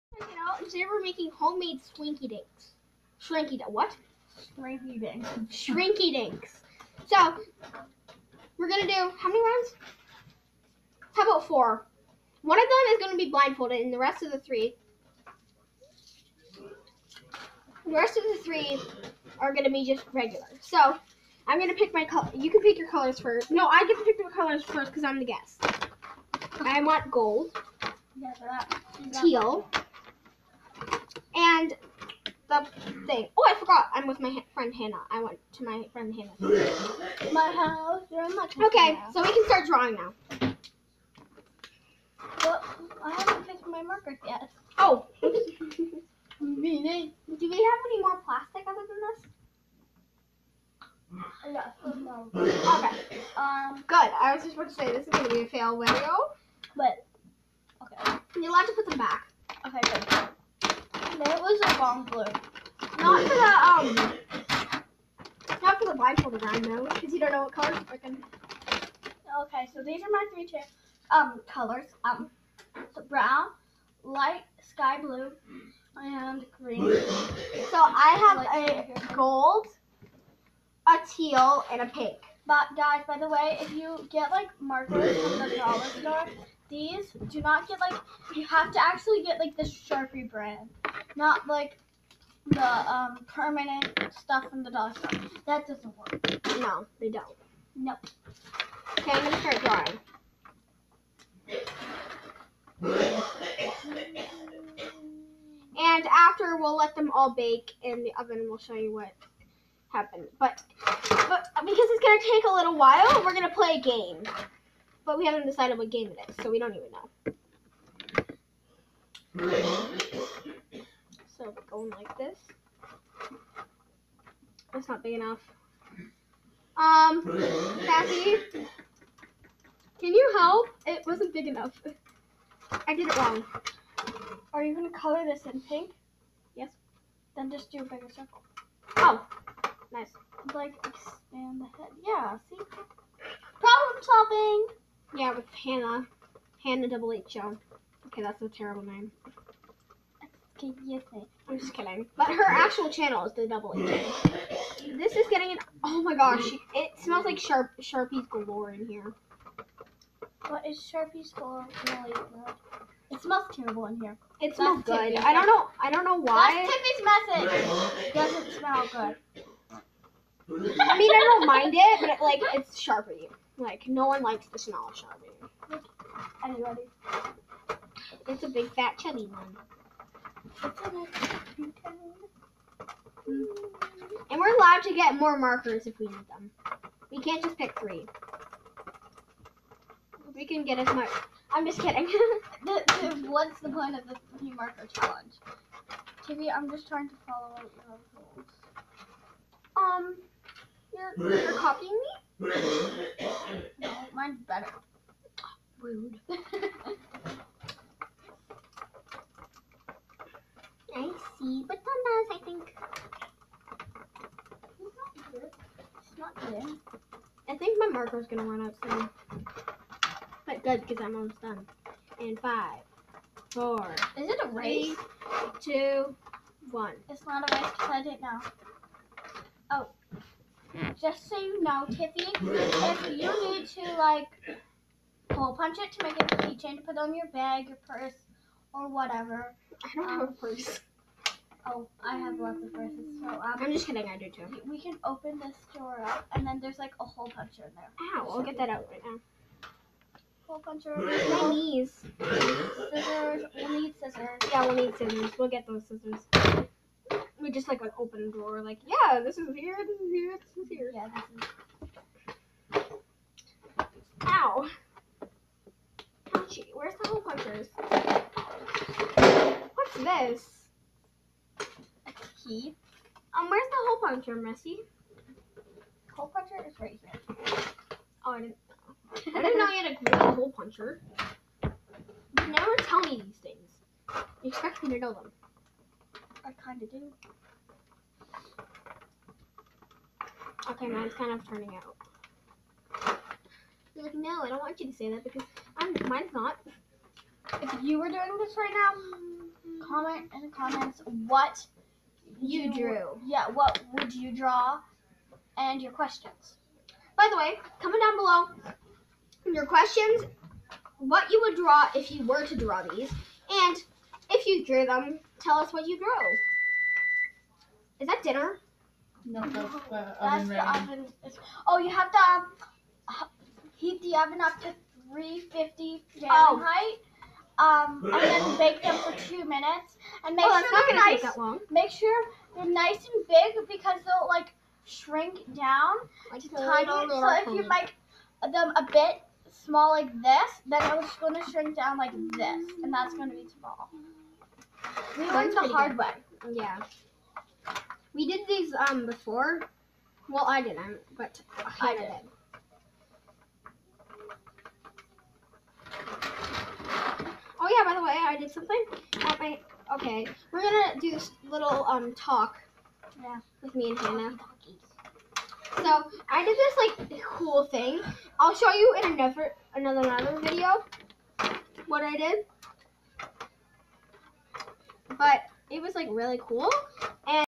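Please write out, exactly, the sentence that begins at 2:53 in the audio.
Like no one likes the smell of Sharpie.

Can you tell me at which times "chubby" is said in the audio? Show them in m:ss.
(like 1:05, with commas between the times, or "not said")
2:58.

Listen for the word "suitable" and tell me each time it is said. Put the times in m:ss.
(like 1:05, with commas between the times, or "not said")
not said.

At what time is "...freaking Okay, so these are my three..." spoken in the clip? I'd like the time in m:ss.
1:07.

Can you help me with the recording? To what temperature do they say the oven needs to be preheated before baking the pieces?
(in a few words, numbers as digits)
350 Fahrenheit.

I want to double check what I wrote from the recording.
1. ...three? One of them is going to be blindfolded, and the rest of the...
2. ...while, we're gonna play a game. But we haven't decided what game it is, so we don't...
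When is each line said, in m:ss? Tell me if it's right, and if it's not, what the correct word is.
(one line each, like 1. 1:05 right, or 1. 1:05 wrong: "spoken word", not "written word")
1. 0:11 wrong: "four", not "three"
2. 1:52 right.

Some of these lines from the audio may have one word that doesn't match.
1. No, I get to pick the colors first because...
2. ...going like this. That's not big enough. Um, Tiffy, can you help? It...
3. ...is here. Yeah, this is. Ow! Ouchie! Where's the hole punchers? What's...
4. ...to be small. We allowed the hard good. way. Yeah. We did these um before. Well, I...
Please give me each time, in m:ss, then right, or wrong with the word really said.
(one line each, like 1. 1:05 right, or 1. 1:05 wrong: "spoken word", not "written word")
1. 0:23 right
2. 2:01 wrong: "Kathy", not "Tiffy"
3. 4:20 right
4. 5:43 wrong: "learned", not "allowed".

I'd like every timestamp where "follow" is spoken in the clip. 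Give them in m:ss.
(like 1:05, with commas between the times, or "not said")
3:17.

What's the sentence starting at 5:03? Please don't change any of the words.
Yeah, what would you draw and your questions.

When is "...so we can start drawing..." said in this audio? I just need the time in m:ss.
0:39.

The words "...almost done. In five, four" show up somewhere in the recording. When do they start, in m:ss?
3:41.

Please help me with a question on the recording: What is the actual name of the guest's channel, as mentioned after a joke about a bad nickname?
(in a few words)
The Double Agent.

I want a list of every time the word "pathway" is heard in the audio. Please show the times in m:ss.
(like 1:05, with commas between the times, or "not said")
not said.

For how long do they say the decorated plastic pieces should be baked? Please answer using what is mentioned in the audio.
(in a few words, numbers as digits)
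2 minutes.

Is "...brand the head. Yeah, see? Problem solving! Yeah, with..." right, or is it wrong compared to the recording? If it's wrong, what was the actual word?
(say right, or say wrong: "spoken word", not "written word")
wrong: "expand", not "brand".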